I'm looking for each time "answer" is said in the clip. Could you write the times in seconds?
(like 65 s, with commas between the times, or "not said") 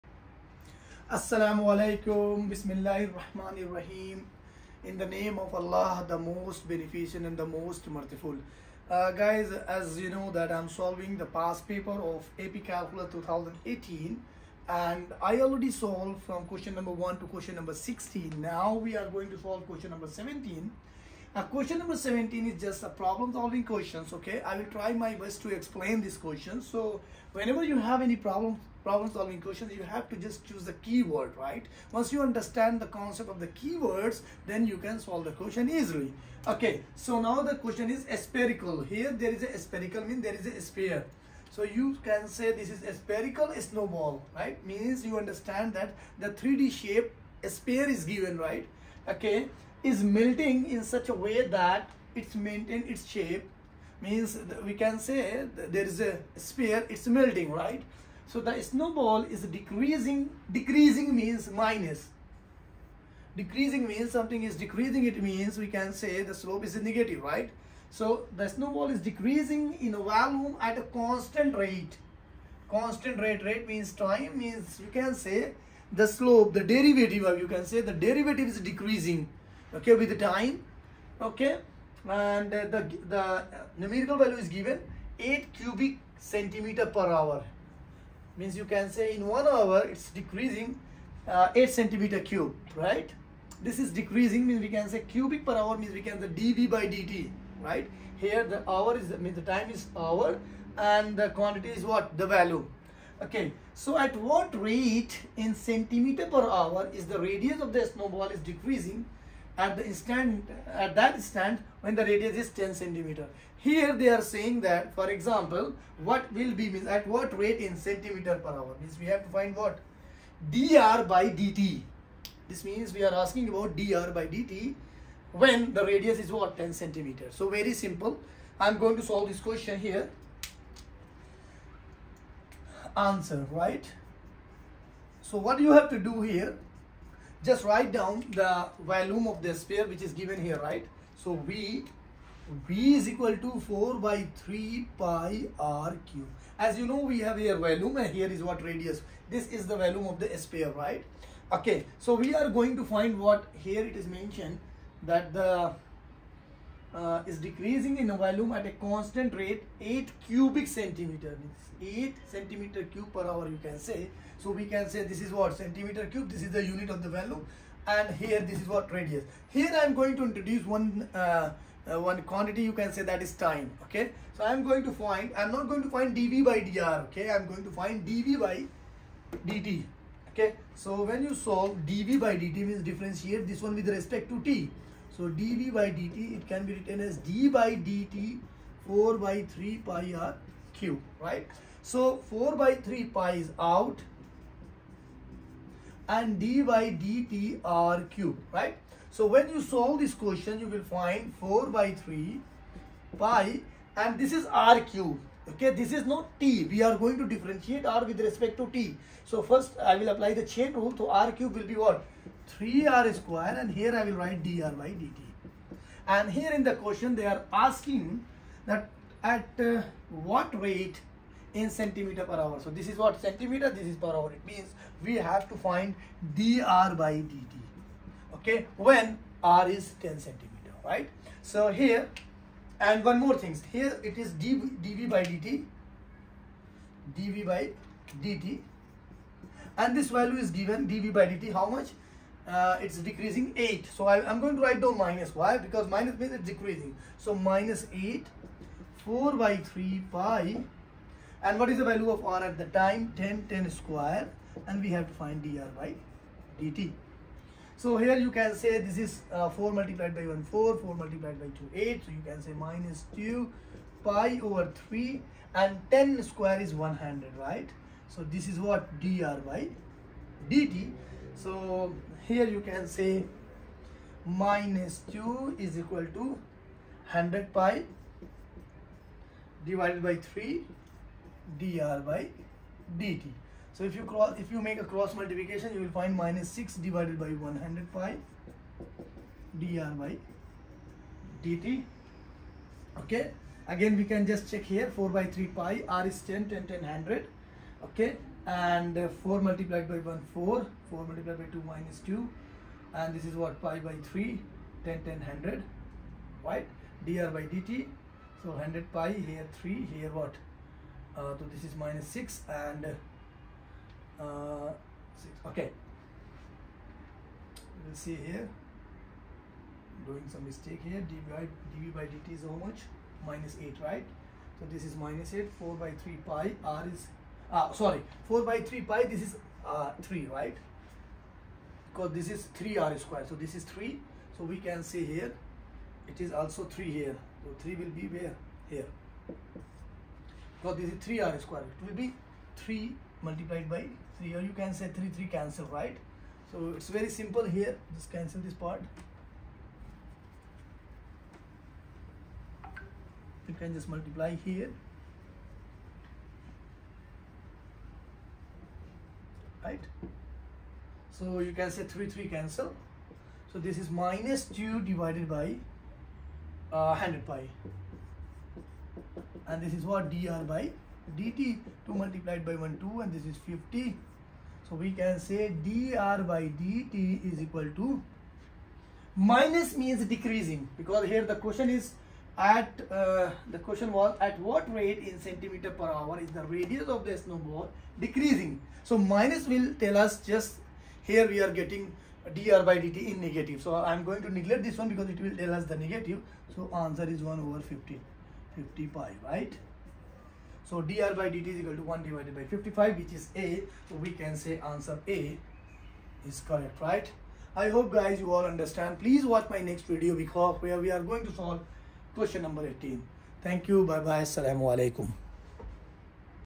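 132 s, 396 s, 404 s.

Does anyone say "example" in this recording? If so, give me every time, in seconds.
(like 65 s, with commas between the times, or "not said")
115 s.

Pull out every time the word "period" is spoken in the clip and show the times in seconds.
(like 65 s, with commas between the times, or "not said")
not said.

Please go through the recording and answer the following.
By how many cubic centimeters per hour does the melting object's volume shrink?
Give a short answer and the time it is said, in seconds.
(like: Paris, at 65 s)
8, at 85 s.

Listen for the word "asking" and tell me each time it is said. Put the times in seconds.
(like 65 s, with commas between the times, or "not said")
123 s, 217 s.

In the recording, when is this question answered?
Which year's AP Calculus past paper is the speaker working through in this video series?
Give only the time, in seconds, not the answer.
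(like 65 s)
13 s.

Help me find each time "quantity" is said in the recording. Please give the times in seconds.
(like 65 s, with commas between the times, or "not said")
101 s, 172 s.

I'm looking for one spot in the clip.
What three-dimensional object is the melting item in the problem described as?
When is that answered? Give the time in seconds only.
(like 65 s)
42 s.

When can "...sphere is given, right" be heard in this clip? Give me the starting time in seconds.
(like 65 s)
47 s.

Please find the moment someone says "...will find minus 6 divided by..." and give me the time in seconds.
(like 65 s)
285 s.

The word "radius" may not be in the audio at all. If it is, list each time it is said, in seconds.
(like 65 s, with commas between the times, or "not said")
107 s, 112 s, 125 s, 148 s, 168 s, 386 s.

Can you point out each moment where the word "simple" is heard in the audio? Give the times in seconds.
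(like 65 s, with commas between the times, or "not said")
127 s, 347 s.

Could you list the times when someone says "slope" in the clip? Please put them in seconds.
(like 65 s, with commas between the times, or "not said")
66 s, 76 s.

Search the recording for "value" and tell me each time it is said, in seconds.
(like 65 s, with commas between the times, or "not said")
84 s, 102 s, 240 s, 251 s.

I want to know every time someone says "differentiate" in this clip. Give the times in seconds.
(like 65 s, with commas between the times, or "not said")
182 s, 207 s.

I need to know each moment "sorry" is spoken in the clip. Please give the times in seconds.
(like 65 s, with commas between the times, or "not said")
327 s.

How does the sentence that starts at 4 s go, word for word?
In the name of Allah, the most beneficent and the most merciful.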